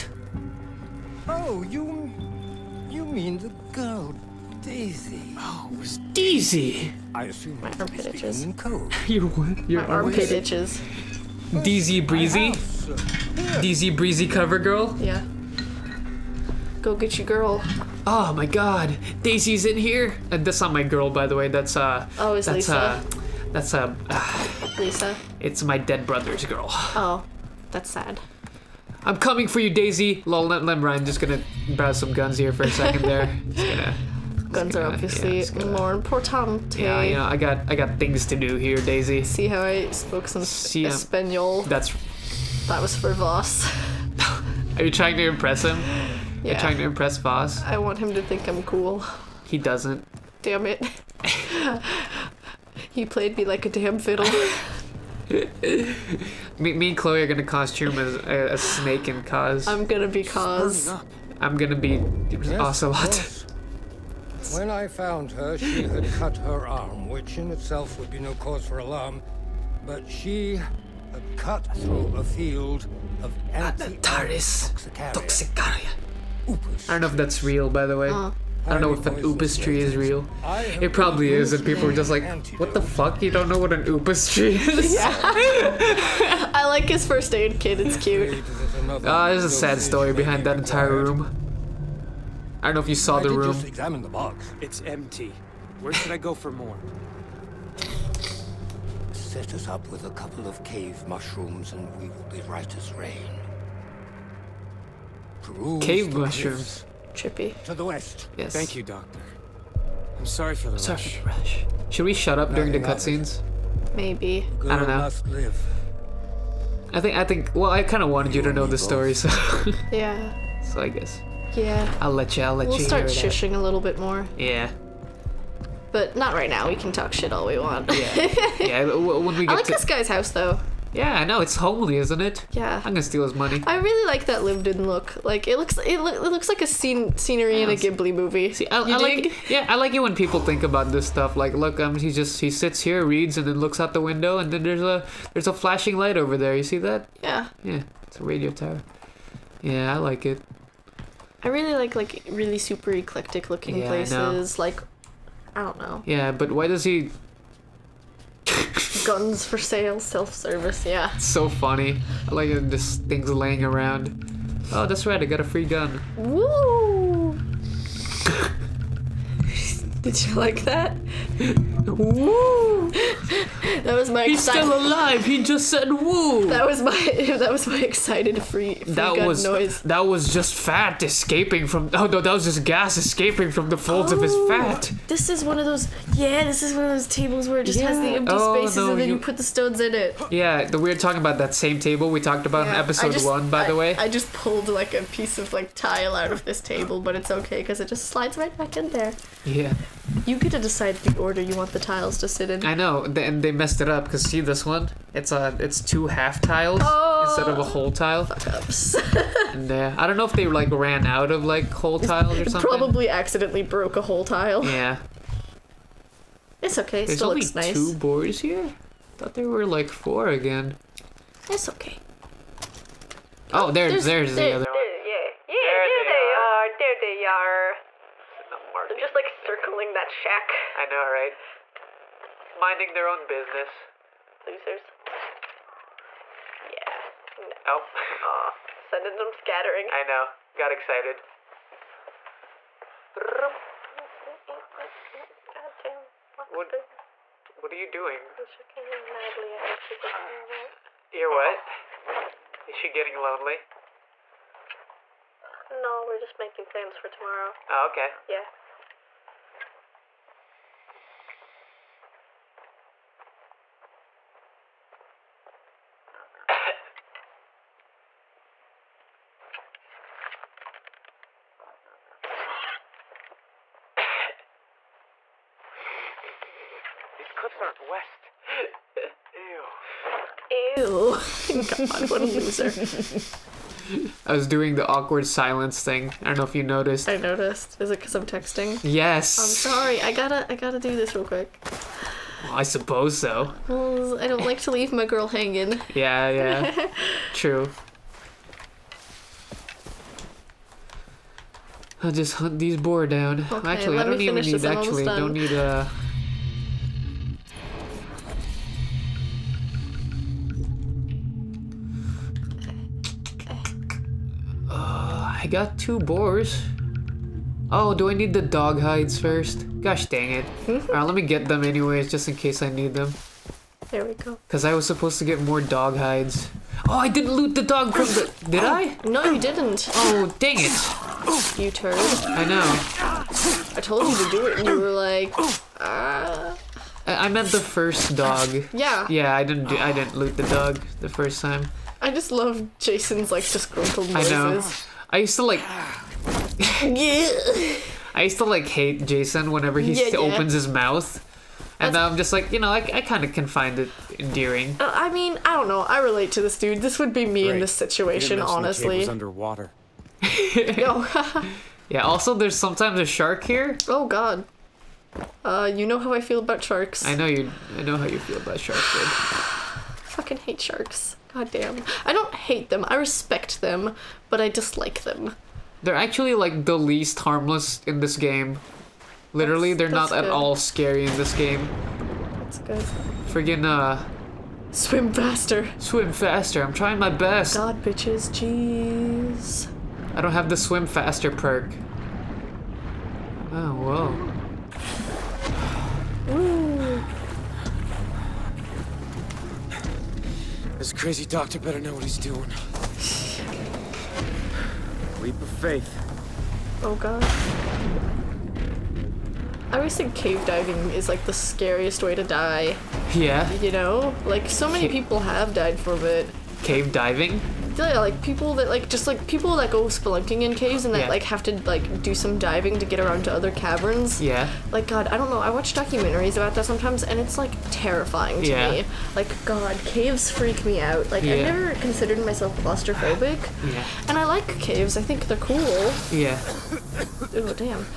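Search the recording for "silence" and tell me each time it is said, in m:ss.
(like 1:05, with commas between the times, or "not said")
4:45.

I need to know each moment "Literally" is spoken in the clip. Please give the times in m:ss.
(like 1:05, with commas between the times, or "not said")
6:19.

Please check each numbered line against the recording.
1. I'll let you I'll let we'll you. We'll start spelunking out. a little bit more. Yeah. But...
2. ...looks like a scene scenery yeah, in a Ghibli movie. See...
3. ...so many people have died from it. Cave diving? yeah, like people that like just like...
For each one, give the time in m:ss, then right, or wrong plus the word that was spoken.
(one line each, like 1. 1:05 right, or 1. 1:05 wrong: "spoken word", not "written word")
1. 2:02 wrong: "shushing", not "spelunking"
2. 2:16 right
3. 6:54 right.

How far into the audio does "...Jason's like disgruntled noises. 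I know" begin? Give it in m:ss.
5:42.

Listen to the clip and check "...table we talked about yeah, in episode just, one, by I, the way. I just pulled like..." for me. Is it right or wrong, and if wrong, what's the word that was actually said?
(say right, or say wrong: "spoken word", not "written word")
right.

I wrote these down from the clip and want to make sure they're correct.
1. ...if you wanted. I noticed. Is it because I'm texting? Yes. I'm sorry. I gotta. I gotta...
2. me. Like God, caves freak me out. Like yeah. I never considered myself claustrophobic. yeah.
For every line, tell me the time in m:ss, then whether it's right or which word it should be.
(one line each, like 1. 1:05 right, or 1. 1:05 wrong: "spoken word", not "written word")
1. 4:46 wrong: "noticed", not "wanted"
2. 7:08 right.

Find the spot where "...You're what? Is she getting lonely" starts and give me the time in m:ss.
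4:11.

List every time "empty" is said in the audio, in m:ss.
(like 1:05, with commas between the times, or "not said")
1:34, 3:08.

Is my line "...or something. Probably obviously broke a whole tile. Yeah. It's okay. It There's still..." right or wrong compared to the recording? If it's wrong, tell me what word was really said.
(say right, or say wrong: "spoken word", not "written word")
wrong: "accidentally", not "obviously".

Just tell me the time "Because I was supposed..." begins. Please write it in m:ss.
5:24.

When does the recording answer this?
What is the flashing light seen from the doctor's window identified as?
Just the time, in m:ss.
2:28.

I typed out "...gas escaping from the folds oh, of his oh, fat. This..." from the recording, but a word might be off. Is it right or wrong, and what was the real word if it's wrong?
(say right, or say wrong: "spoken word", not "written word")
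right.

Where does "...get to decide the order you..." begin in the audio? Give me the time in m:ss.
3:20.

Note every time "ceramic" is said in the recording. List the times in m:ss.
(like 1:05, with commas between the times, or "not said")
not said.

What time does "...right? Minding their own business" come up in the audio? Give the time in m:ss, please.
3:51.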